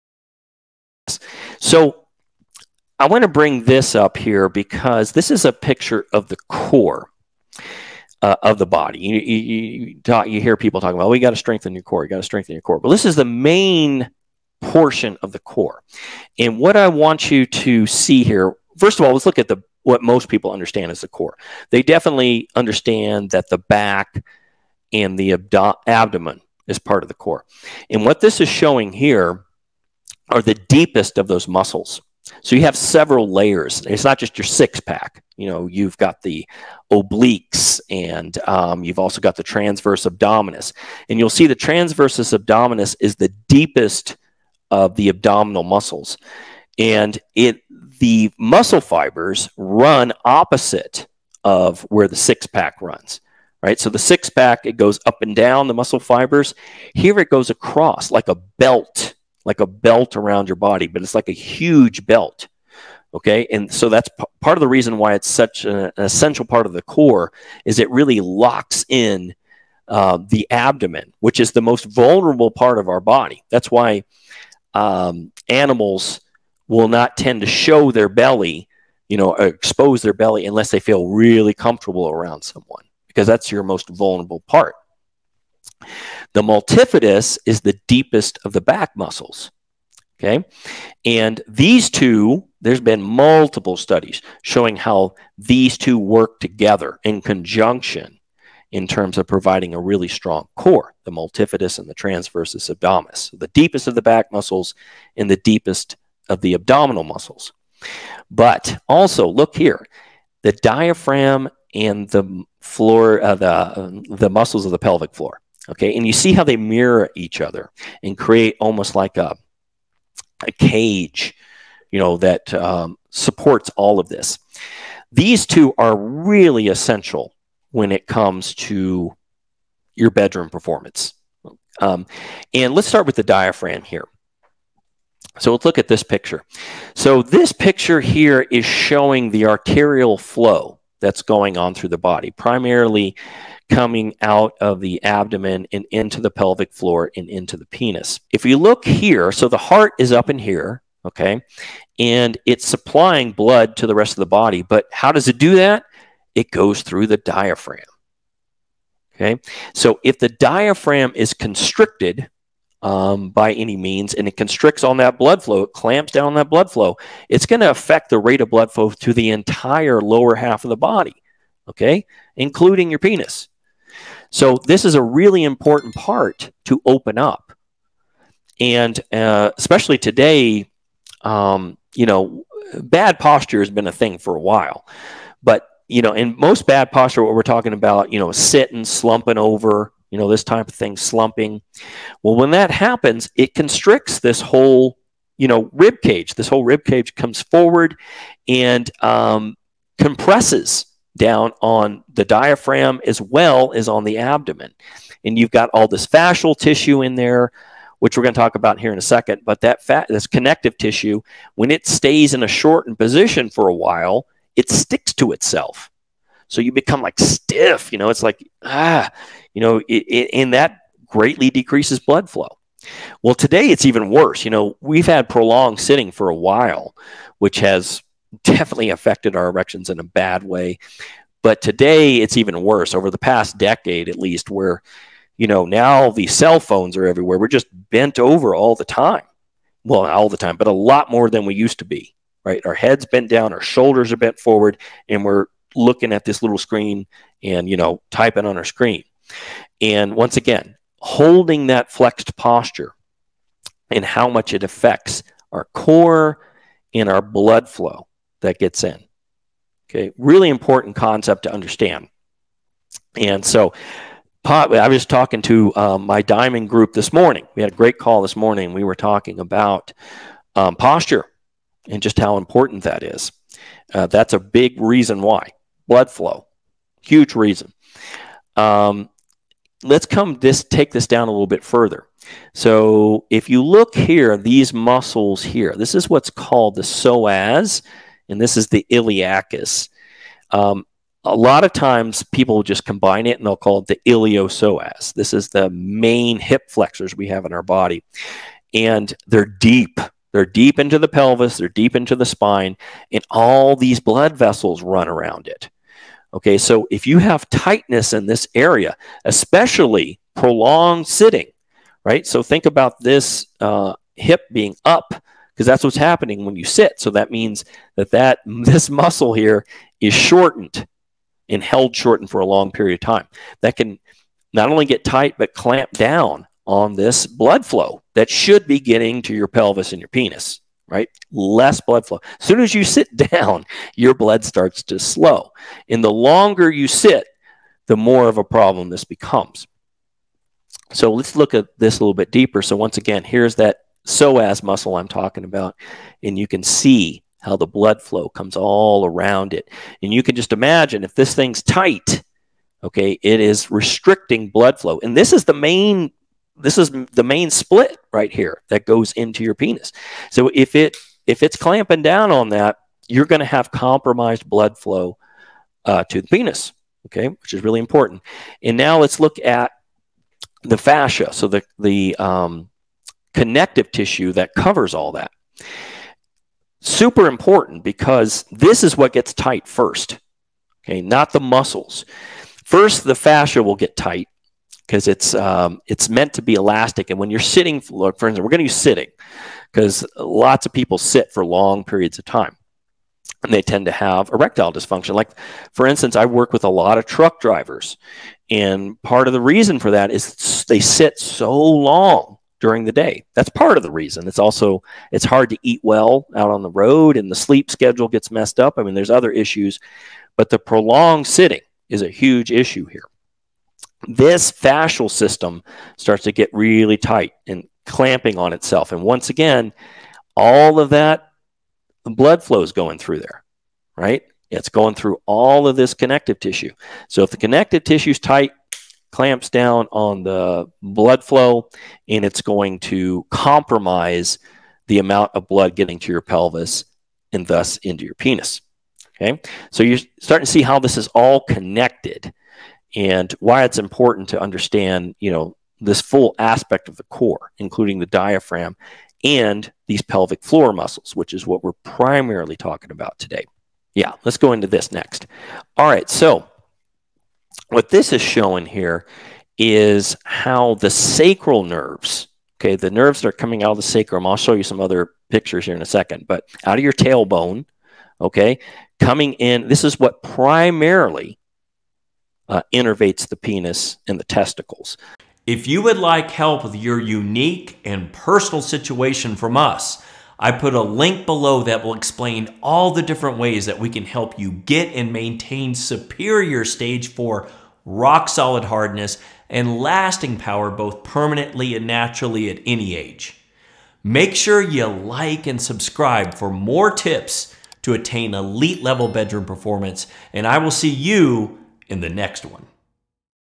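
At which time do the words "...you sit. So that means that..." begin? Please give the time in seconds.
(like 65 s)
316 s.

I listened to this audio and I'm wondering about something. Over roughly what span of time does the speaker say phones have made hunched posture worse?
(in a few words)
past decade.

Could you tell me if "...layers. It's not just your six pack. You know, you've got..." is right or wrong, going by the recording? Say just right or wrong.
right.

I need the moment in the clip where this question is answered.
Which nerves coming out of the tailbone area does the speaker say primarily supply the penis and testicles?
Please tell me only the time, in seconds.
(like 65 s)
460 s.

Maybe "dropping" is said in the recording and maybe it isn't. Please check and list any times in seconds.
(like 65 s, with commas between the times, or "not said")
not said.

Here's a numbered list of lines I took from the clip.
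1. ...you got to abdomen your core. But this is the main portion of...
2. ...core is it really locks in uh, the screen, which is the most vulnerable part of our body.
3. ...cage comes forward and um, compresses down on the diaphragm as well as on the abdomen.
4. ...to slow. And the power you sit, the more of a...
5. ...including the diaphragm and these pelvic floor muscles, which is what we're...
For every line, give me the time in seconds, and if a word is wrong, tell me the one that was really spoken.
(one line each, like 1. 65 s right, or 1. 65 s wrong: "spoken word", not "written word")
1. 12 s wrong: "strengthen", not "abdomen"
2. 66 s wrong: "abdomen", not "screen"
3. 196 s right
4. 334 s wrong: "longer", not "power"
5. 447 s right.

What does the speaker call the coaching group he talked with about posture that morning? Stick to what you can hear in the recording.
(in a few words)
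diamond group.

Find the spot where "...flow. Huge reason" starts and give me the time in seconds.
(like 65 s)
276 s.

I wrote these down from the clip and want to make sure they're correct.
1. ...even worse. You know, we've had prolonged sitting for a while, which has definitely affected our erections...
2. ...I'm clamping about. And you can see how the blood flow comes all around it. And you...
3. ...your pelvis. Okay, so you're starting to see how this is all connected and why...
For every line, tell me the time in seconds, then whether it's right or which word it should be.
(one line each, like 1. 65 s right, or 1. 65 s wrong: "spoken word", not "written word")
1. 223 s right
2. 344 s wrong: "talking", not "clamping"
3. 438 s wrong: "penis", not "pelvis".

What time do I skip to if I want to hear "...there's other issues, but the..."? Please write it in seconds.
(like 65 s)
408 s.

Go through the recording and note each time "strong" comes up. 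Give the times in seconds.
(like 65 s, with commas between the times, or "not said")
100 s.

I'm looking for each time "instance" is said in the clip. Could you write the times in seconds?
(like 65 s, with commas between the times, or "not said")
388 s, 395 s.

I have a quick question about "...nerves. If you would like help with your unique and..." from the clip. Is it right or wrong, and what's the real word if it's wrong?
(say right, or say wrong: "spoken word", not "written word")
wrong: "testicles", not "nerves".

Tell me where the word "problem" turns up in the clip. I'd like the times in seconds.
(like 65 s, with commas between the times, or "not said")
338 s.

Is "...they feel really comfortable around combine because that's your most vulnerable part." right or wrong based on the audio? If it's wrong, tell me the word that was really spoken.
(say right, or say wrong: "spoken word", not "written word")
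wrong: "someone", not "combine".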